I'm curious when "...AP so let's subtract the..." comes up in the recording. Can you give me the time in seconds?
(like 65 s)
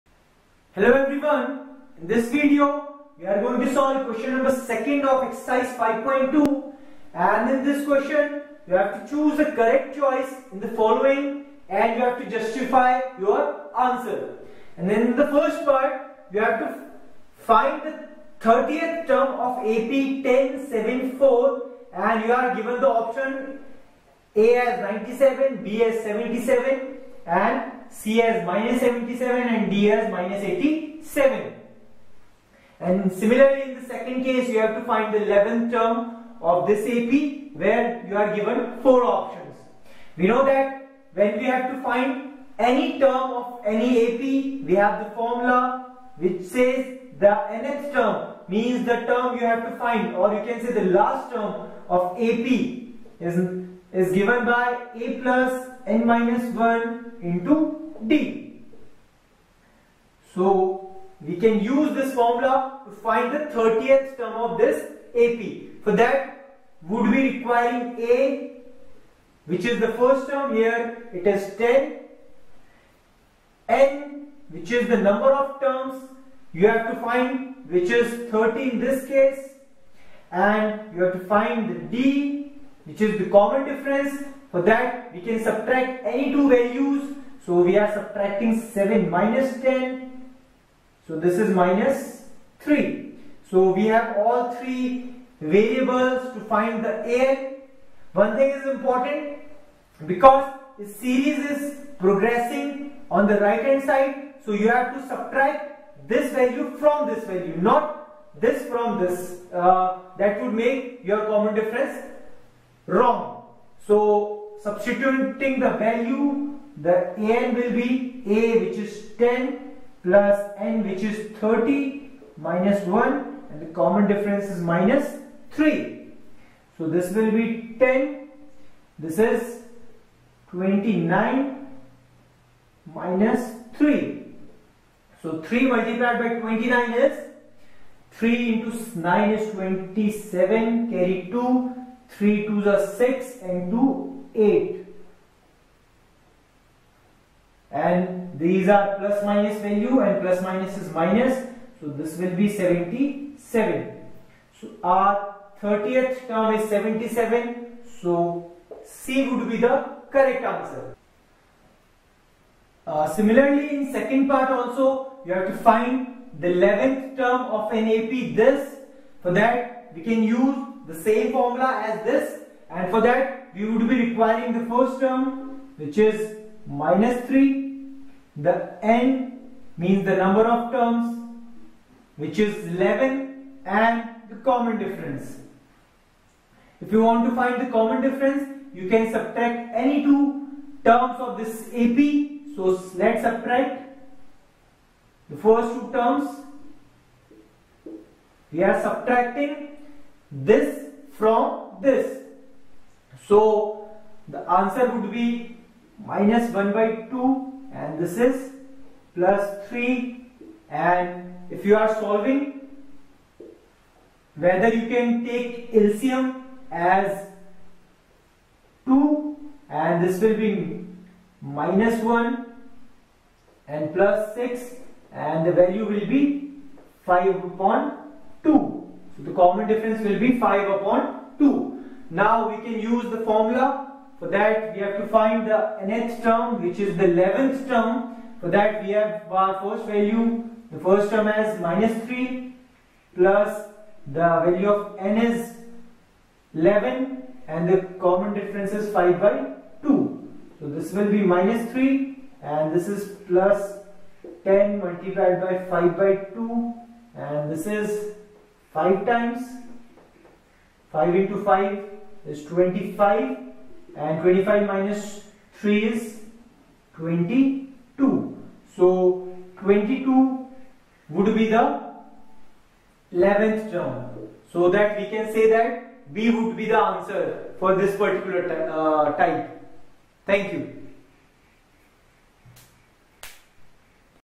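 191 s.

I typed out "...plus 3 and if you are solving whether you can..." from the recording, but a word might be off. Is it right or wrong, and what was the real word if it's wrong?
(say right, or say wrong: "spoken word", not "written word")
right.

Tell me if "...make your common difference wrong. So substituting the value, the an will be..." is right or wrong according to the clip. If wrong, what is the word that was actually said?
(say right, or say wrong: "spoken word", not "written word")
right.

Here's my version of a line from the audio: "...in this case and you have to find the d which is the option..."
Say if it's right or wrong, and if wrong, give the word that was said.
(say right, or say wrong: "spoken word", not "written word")
wrong: "common", not "option".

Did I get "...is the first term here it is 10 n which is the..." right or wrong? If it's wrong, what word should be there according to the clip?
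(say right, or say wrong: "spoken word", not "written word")
right.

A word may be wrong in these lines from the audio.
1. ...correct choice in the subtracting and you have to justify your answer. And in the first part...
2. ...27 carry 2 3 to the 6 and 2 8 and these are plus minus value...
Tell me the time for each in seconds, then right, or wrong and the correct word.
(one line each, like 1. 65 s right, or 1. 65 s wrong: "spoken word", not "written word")
1. 9 s wrong: "following", not "subtracting"
2. 139 s right.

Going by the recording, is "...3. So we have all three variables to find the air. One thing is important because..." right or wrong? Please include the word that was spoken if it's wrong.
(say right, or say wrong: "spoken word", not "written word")
right.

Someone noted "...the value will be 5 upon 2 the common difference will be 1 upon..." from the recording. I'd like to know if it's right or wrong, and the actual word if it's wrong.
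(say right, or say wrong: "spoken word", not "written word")
wrong: "5", not "1".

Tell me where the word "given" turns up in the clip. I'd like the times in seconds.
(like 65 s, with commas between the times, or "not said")
22 s, 38 s, 54 s.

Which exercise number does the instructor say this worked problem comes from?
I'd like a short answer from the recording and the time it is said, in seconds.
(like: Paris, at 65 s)
5.2, at 5 s.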